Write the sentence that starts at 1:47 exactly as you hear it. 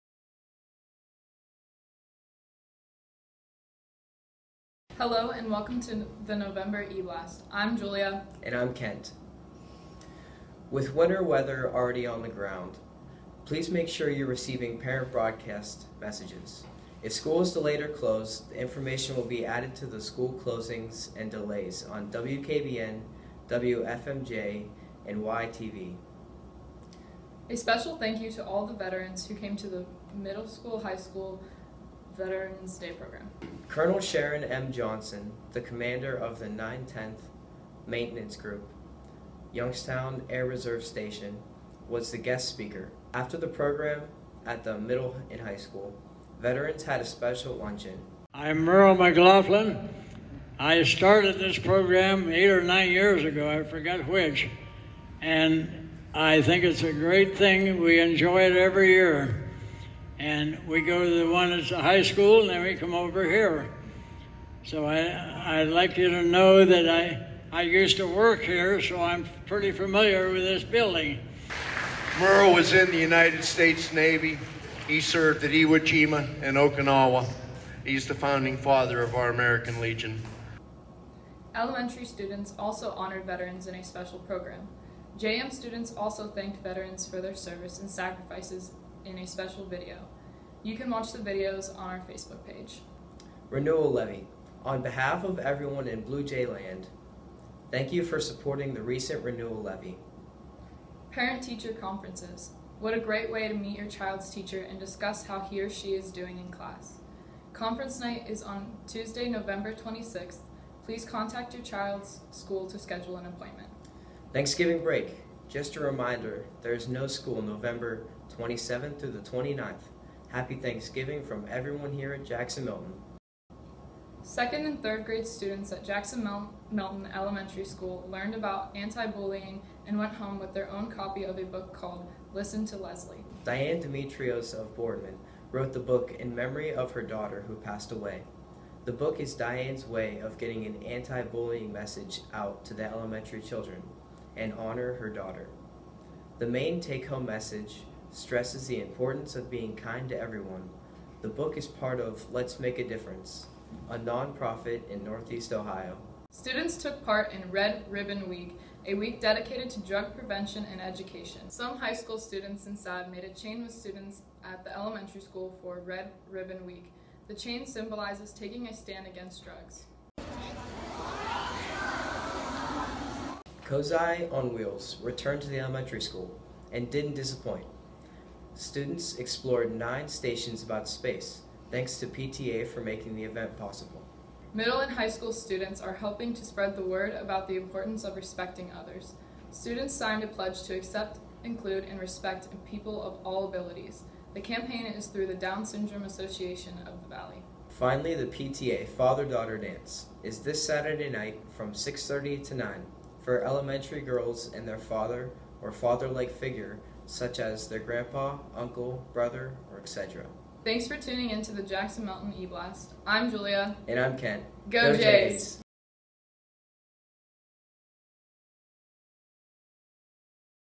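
Conference night is on Tuesday, November 26th.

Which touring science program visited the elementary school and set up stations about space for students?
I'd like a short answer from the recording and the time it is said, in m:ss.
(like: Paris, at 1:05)
COSI on Wheels, at 2:53.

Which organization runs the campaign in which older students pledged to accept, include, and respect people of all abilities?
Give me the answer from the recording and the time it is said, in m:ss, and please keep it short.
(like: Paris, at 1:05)
Down Syndrome Association of the Valley, at 3:15.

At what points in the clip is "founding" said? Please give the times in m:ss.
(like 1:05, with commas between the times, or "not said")
1:18.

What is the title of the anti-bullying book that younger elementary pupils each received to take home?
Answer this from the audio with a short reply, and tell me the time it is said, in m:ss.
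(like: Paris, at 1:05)
Listen to Leslie, at 2:12.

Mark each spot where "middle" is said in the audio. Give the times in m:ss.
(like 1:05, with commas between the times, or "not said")
0:30, 0:44, 3:04.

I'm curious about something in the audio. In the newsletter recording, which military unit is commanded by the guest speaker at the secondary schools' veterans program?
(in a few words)
910th Maintenance Group.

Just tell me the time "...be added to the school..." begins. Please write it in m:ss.
0:19.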